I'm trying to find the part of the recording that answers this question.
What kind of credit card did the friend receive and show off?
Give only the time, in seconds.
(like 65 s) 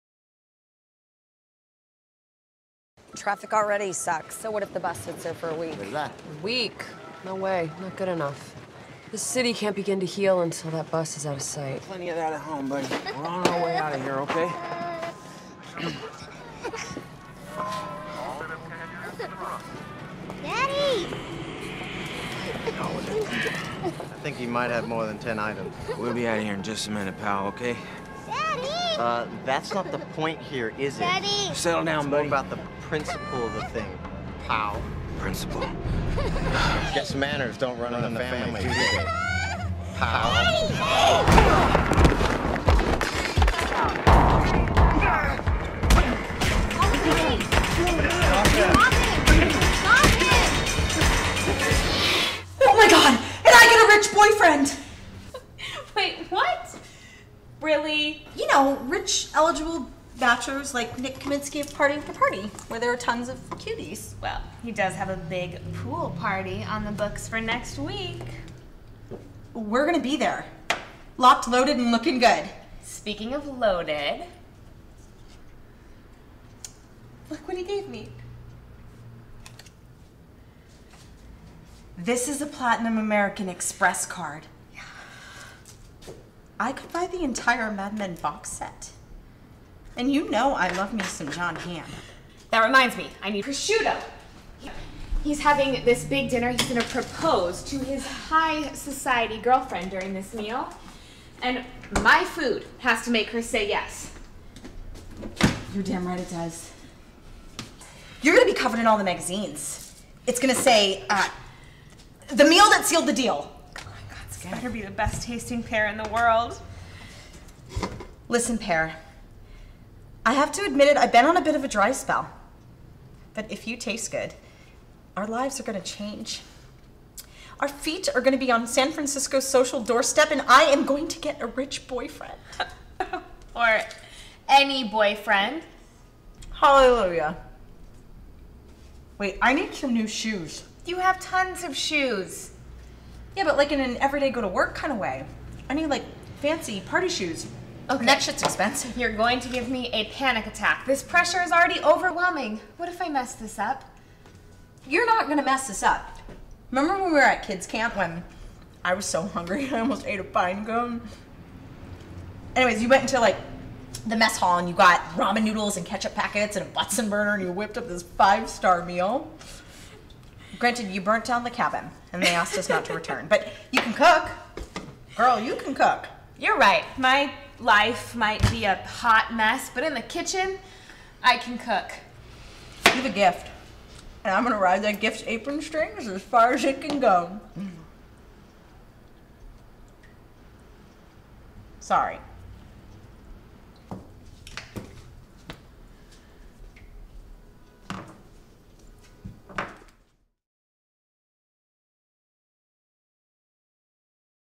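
82 s.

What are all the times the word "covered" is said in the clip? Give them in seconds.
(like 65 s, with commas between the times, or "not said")
108 s.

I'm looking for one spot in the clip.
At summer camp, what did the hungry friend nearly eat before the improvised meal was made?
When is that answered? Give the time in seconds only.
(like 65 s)
160 s.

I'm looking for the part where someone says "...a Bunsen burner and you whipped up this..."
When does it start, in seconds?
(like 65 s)
166 s.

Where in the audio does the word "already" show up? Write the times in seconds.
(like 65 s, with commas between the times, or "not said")
3 s, 151 s.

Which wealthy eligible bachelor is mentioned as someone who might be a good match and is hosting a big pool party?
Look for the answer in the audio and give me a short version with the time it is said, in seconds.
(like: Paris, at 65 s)
Nick Kaminsky, at 60 s.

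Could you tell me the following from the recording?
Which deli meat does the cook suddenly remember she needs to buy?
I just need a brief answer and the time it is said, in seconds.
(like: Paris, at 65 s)
prosciutto, at 93 s.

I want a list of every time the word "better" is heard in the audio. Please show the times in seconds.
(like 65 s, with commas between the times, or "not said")
114 s.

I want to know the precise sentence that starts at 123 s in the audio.
But if you taste good, our lives are going to change.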